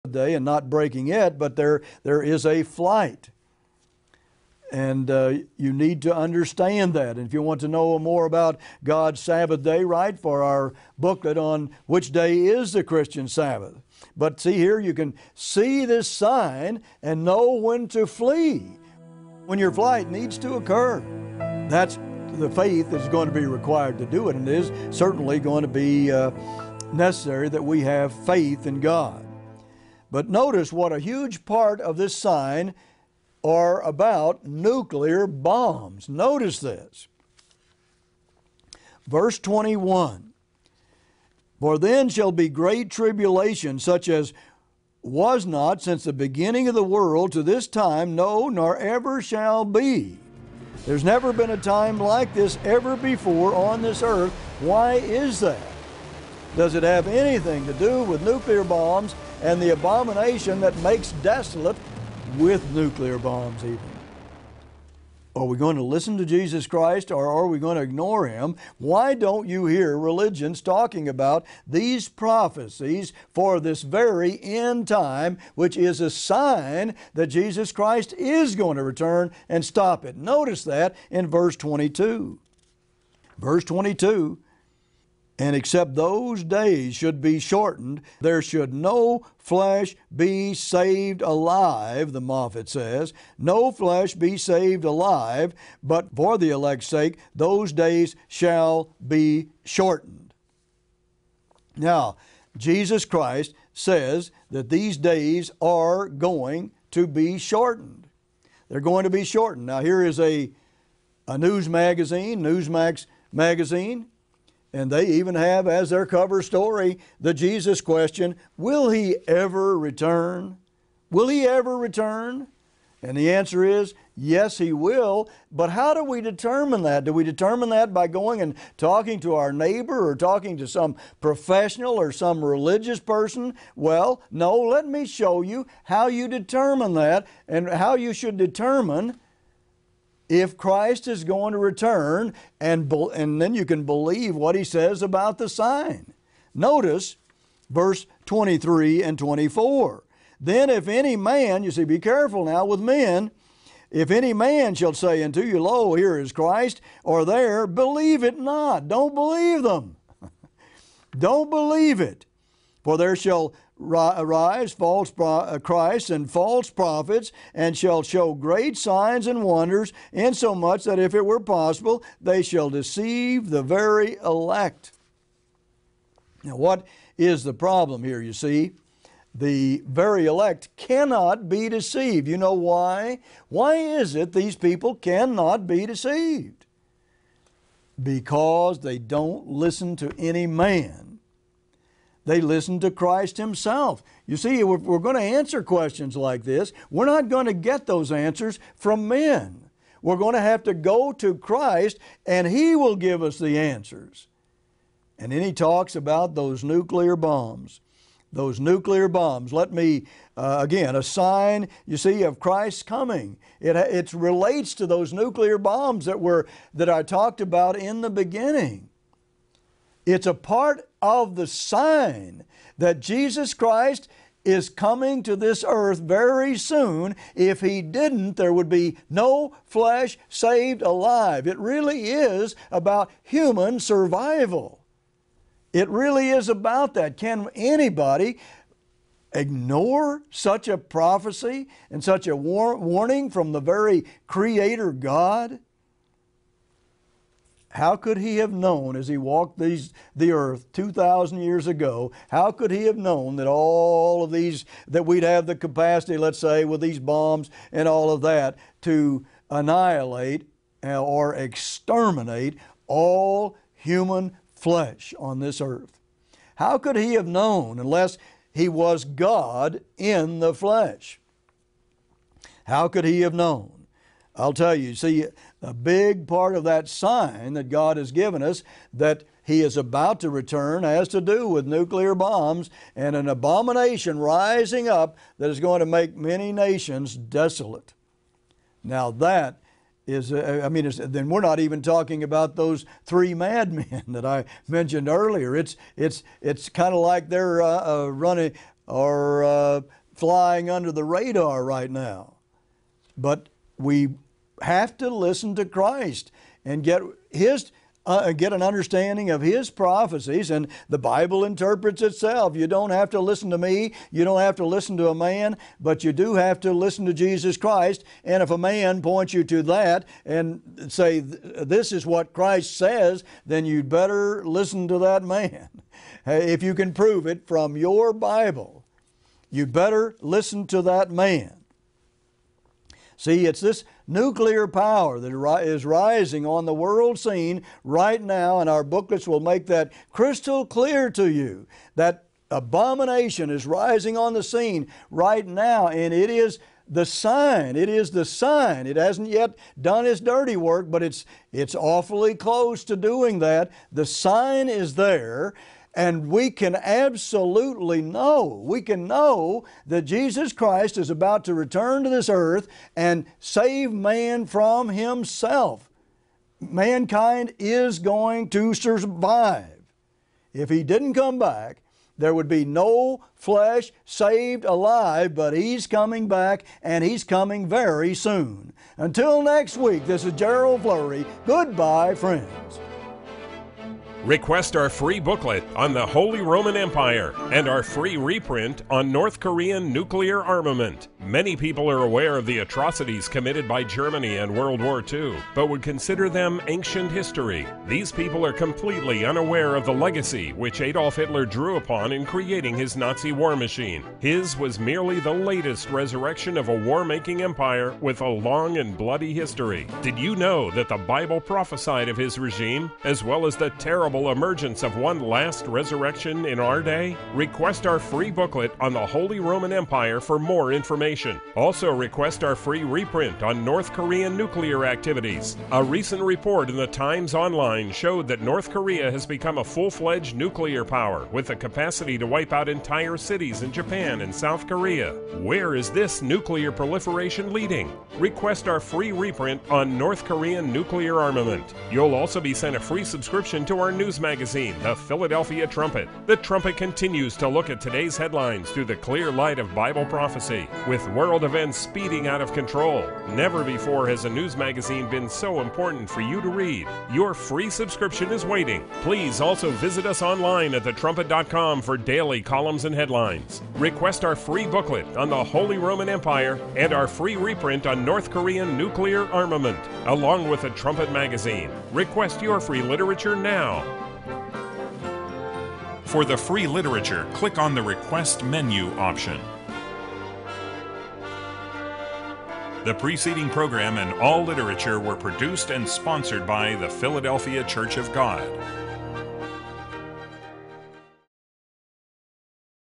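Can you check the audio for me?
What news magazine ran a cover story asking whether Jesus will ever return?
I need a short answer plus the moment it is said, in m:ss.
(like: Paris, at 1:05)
Newsmax, at 1:52.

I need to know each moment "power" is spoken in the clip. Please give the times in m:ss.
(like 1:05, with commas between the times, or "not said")
5:34, 7:10.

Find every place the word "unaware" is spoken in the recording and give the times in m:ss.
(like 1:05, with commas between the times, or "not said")
6:39.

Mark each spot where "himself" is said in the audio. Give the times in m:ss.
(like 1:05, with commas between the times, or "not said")
3:13, 6:04.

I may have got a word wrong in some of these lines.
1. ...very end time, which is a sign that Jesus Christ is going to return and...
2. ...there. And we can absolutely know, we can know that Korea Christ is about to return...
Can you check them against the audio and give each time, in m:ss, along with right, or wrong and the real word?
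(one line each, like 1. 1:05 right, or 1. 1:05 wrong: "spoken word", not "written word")
1. 1:13 right
2. 5:54 wrong: "Jesus", not "Korea".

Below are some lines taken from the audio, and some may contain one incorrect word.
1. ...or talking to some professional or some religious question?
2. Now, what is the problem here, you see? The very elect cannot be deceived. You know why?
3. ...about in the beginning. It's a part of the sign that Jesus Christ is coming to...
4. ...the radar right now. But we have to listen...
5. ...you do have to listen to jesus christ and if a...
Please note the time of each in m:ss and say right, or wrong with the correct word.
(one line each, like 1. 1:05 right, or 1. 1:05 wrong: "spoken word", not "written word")
1. 2:10 wrong: "person", not "question"
2. 2:56 right
3. 3:37 right
4. 5:00 right
5. 5:16 right.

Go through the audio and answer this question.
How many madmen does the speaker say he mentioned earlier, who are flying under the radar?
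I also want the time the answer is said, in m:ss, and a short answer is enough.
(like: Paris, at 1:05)
3, at 4:53.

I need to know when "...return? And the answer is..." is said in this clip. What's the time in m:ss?
2:01.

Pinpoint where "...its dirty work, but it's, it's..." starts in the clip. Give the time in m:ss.
5:50.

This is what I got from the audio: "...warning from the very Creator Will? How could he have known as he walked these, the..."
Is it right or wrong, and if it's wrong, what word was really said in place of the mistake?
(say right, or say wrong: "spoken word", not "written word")
wrong: "God", not "Will".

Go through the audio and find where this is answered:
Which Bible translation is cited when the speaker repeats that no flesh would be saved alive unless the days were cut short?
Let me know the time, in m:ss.
1:32.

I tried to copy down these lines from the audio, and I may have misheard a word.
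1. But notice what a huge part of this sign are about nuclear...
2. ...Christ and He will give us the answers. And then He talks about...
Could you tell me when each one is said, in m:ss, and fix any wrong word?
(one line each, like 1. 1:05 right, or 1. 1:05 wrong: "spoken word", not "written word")
1. 0:30 right
2. 3:21 right.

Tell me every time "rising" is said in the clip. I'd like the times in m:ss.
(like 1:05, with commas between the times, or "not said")
4:44, 5:35, 5:43.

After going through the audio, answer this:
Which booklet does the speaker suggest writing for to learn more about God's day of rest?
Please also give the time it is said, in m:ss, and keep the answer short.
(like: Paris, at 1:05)
Which Day Is the Christian Sabbath, at 0:11.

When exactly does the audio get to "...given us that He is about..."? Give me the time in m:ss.
4:38.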